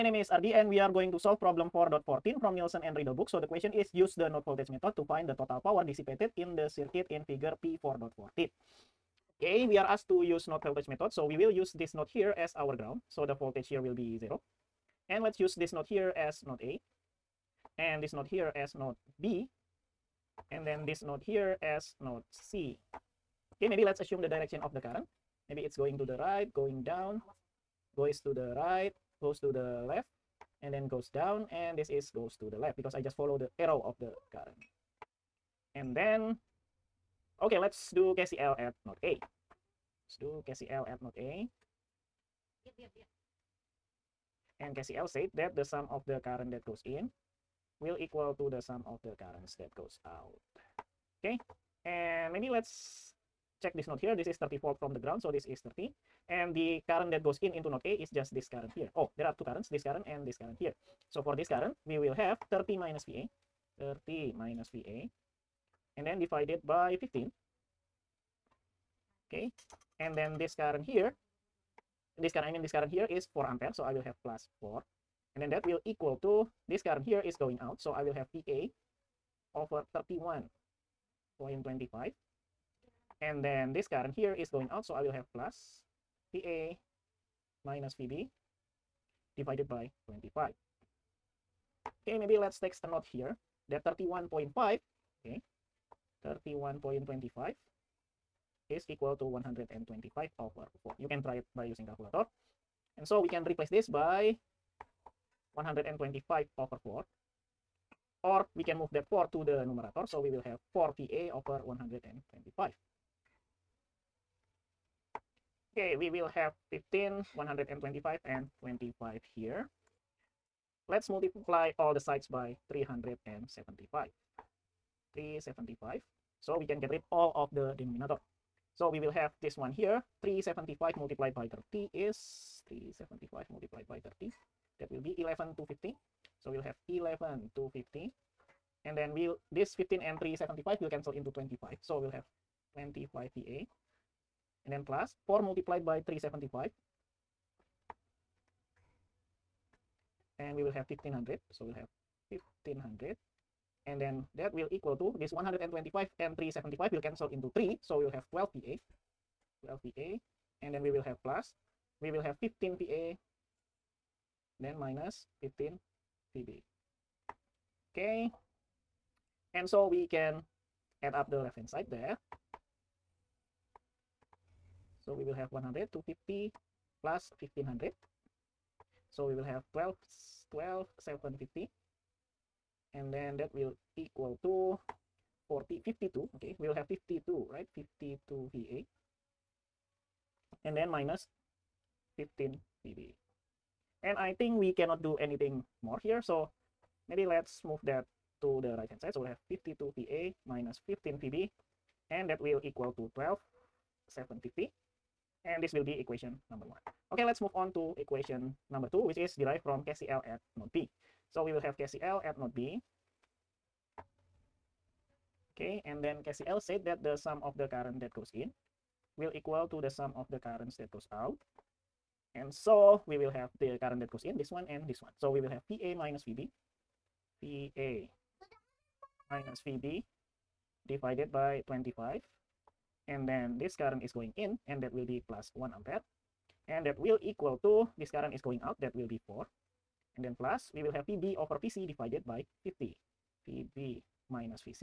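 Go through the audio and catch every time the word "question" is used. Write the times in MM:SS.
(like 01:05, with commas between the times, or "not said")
00:03.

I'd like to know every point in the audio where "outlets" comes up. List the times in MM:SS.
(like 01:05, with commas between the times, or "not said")
not said.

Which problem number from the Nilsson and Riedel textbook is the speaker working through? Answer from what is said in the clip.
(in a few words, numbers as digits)
4.14.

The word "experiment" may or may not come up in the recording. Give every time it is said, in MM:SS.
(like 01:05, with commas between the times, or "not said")
not said.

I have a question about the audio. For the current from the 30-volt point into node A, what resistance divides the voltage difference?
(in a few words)
15.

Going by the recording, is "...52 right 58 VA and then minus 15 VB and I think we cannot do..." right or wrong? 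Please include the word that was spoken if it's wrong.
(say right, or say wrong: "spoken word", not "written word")
wrong: "52", not "58".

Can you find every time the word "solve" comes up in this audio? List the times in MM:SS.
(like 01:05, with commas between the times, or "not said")
00:01.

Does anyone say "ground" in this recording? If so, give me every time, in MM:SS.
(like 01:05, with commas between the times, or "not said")
00:12, 00:54.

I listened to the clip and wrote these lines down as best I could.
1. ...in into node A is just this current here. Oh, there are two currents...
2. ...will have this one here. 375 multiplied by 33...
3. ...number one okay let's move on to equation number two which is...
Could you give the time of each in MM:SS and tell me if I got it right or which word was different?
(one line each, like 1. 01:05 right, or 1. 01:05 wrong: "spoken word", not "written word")
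1. 00:57 right
2. 02:09 wrong: "30", not "33"
3. 03:26 right.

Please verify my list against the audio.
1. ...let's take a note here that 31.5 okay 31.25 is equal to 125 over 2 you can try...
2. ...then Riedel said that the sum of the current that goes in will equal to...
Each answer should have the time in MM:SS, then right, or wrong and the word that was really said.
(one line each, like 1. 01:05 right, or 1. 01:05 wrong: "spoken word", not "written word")
1. 01:32 wrong: "4", not "2"
2. 03:36 wrong: "KCL", not "Riedel".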